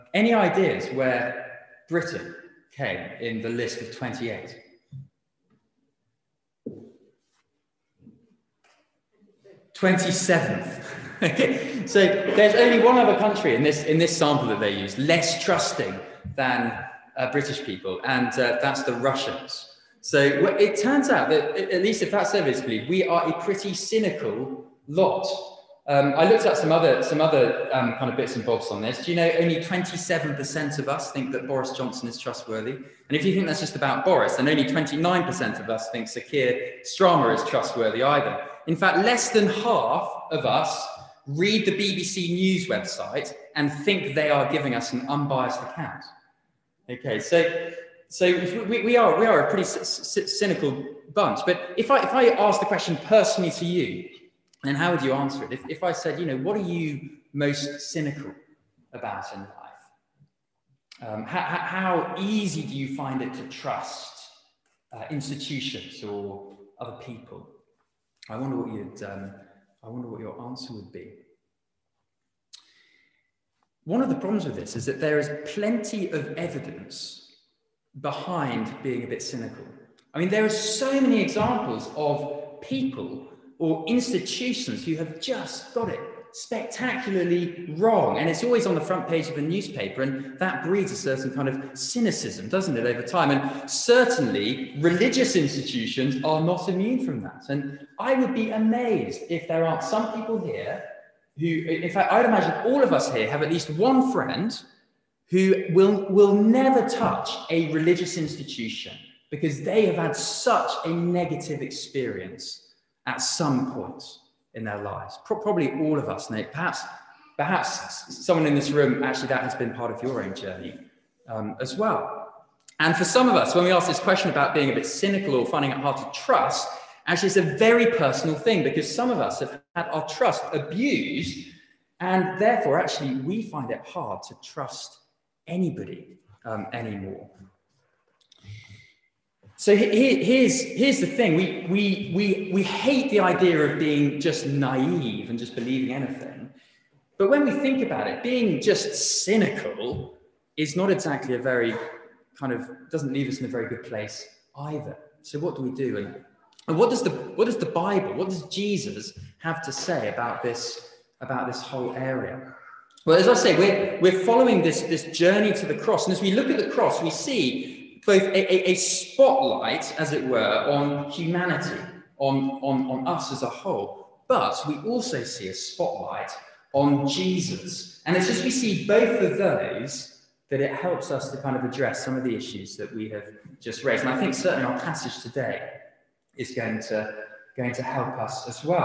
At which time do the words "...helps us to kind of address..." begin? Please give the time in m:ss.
3:00.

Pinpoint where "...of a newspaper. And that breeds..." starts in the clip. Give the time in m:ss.
1:29.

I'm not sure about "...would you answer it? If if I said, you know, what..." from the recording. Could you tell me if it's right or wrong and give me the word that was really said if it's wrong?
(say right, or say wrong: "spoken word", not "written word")
right.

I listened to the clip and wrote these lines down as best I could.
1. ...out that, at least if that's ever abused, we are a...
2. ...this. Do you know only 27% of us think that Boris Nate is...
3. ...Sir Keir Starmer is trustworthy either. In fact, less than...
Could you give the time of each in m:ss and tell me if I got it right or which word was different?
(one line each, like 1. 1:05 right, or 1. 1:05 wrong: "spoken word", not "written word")
1. 0:21 wrong: "believed", not "abused"
2. 0:28 wrong: "Johnson", not "Nate"
3. 0:36 right.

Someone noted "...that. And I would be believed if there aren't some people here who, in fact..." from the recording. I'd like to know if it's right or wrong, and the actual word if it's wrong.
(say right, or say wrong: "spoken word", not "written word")
wrong: "amazed", not "believed".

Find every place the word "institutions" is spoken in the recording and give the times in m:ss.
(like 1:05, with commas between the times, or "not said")
1:05, 1:23, 1:35, 1:48.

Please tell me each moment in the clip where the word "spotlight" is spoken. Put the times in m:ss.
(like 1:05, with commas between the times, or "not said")
2:48, 2:55.